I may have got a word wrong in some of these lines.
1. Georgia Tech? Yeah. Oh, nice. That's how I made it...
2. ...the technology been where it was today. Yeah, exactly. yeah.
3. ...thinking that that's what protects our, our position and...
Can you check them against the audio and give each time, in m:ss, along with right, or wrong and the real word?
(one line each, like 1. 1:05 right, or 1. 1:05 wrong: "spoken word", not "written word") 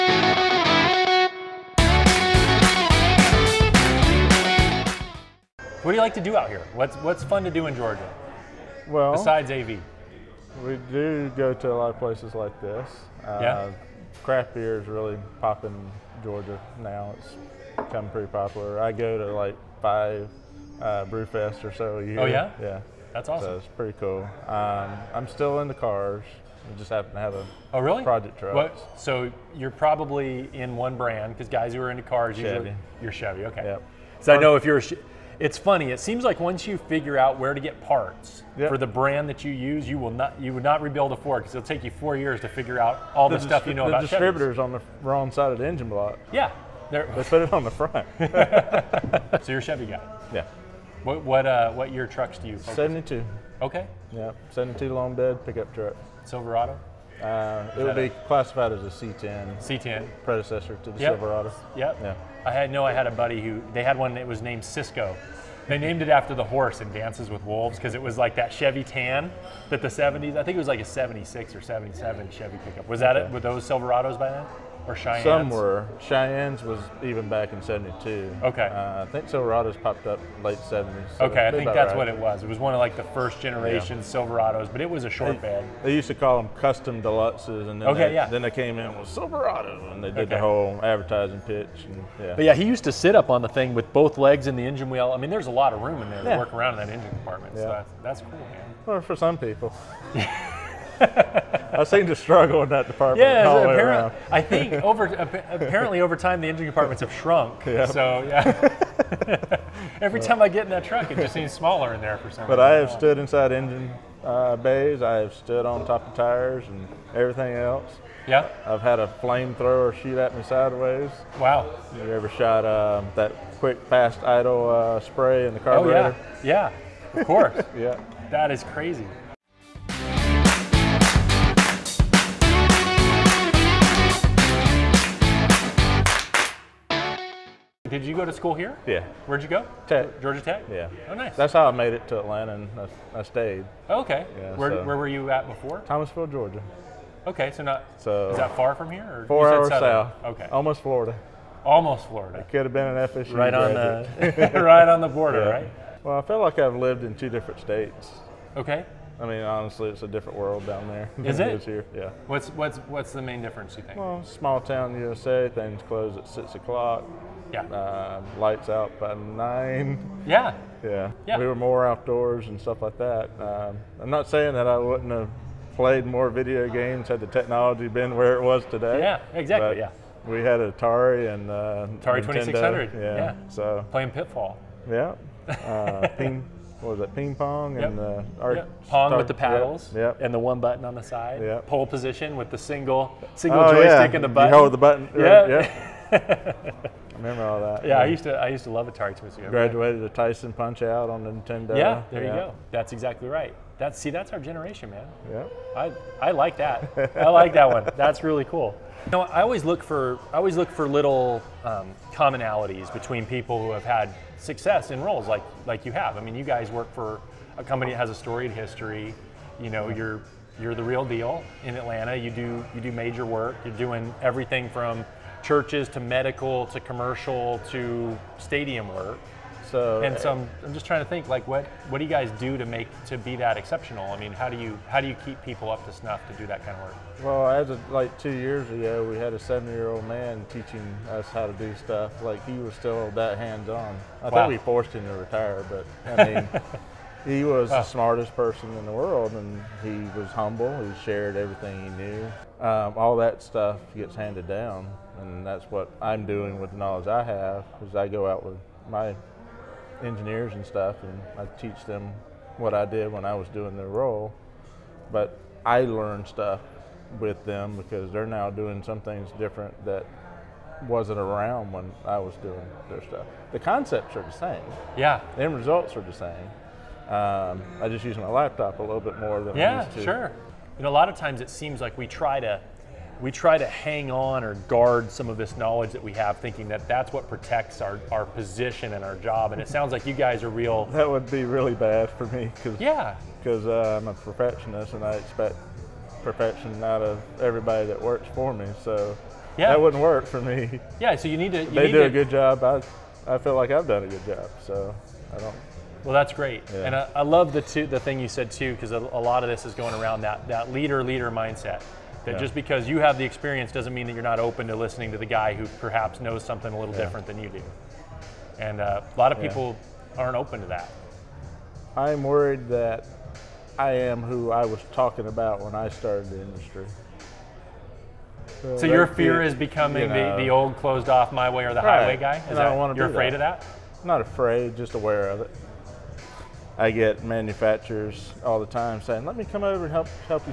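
1. 2:20 right
2. 2:57 right
3. 4:46 right.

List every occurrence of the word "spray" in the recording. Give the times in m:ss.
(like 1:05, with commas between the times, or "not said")
2:05.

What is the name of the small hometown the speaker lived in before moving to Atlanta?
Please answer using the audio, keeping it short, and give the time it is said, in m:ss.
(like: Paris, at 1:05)
Thomasville, Georgia, at 2:25.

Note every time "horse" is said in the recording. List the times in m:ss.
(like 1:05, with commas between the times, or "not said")
1:06.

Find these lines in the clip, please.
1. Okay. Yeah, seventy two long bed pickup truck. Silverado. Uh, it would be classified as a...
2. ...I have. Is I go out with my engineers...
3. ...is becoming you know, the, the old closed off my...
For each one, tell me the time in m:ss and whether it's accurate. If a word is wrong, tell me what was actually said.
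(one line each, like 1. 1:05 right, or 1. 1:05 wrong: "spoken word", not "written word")
1. 0:53 right
2. 4:17 right
3. 5:29 right.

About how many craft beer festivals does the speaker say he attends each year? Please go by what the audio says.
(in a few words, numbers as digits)
5.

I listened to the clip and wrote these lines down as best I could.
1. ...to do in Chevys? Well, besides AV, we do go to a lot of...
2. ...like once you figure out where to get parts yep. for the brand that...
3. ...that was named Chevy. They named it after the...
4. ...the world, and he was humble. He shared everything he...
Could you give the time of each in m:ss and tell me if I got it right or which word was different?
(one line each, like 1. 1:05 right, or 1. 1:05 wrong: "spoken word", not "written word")
1. 0:07 wrong: "Georgia", not "Chevys"
2. 0:36 right
3. 1:04 wrong: "Cisco", not "Chevy"
4. 4:08 right.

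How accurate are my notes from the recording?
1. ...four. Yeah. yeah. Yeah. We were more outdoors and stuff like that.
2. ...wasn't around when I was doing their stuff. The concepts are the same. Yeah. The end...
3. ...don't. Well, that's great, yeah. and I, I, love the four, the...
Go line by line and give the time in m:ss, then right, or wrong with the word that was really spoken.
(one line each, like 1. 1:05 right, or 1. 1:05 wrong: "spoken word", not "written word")
1. 2:49 wrong: "nine", not "four"
2. 4:30 right
3. 5:05 wrong: "two", not "four".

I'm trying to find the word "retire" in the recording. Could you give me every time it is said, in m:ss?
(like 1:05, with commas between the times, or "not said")
4:05.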